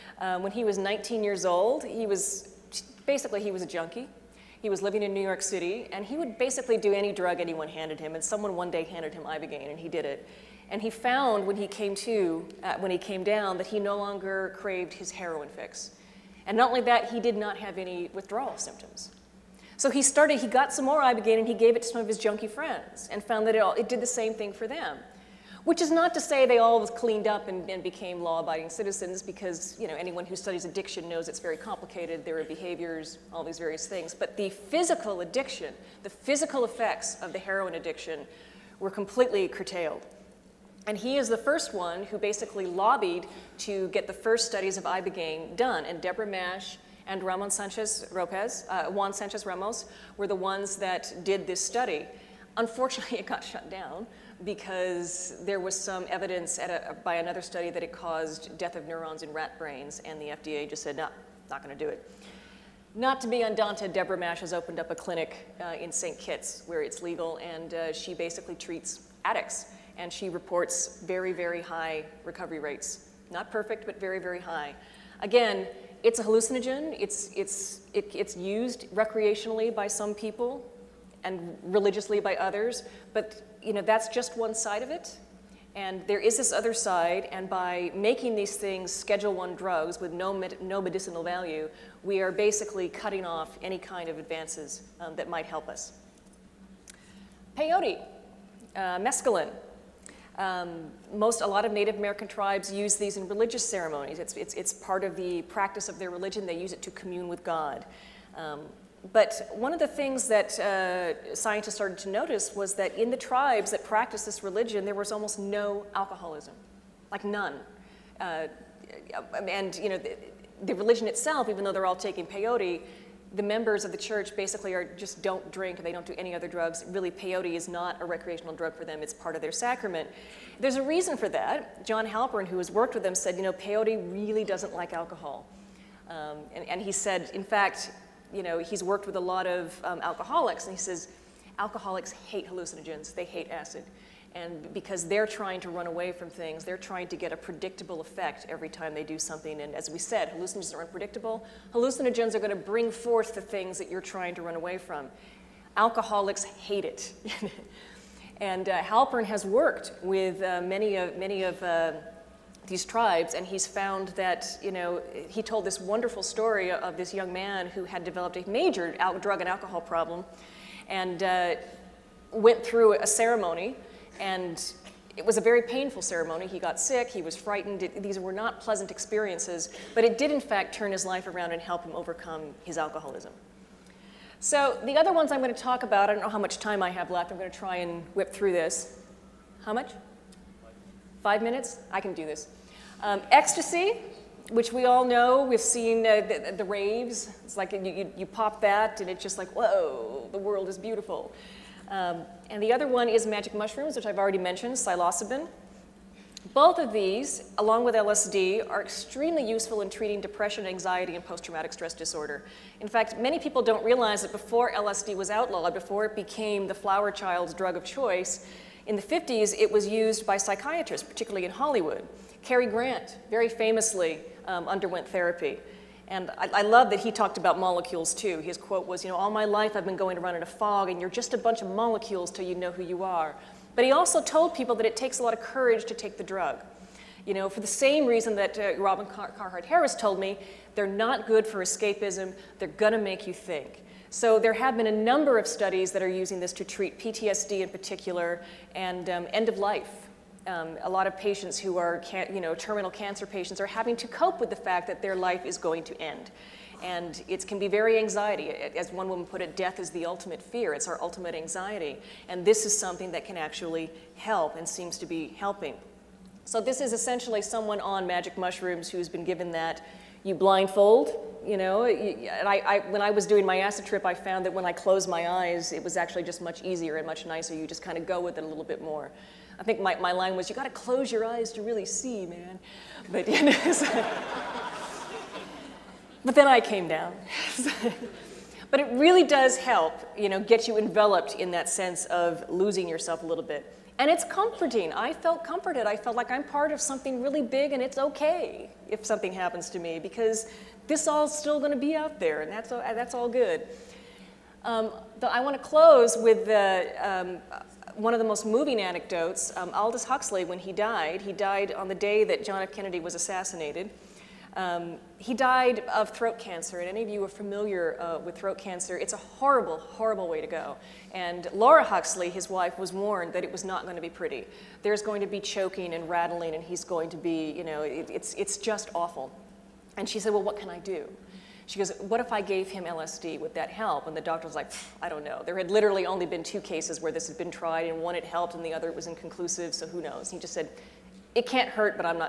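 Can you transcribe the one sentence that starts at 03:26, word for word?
Both of these, along with LSD, are extremely useful in treating depression, anxiety, and post-traumatic stress disorder.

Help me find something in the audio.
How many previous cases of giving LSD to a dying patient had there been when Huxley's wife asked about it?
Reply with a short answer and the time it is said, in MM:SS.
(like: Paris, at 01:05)
2, at 05:36.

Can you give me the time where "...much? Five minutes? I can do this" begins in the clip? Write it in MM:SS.
03:09.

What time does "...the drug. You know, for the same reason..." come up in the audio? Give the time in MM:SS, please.
03:56.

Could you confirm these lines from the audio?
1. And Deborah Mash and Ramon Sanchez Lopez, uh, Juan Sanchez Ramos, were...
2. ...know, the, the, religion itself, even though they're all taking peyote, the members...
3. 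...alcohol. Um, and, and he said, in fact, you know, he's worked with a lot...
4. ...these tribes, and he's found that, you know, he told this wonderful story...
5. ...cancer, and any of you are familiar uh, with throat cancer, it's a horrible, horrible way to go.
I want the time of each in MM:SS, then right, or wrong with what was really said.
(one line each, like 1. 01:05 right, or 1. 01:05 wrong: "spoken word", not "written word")
1. 00:45 right
2. 01:59 right
3. 02:14 right
4. 02:42 right
5. 05:16 right.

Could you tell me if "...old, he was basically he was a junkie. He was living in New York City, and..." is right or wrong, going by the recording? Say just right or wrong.
right.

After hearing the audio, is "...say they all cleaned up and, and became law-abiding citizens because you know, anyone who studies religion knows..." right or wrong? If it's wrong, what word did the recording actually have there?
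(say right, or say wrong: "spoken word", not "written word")
wrong: "addiction", not "religion".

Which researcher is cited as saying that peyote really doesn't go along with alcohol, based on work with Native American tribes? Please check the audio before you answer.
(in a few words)
John Halpern.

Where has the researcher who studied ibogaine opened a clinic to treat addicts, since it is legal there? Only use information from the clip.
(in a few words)
St. Kitts.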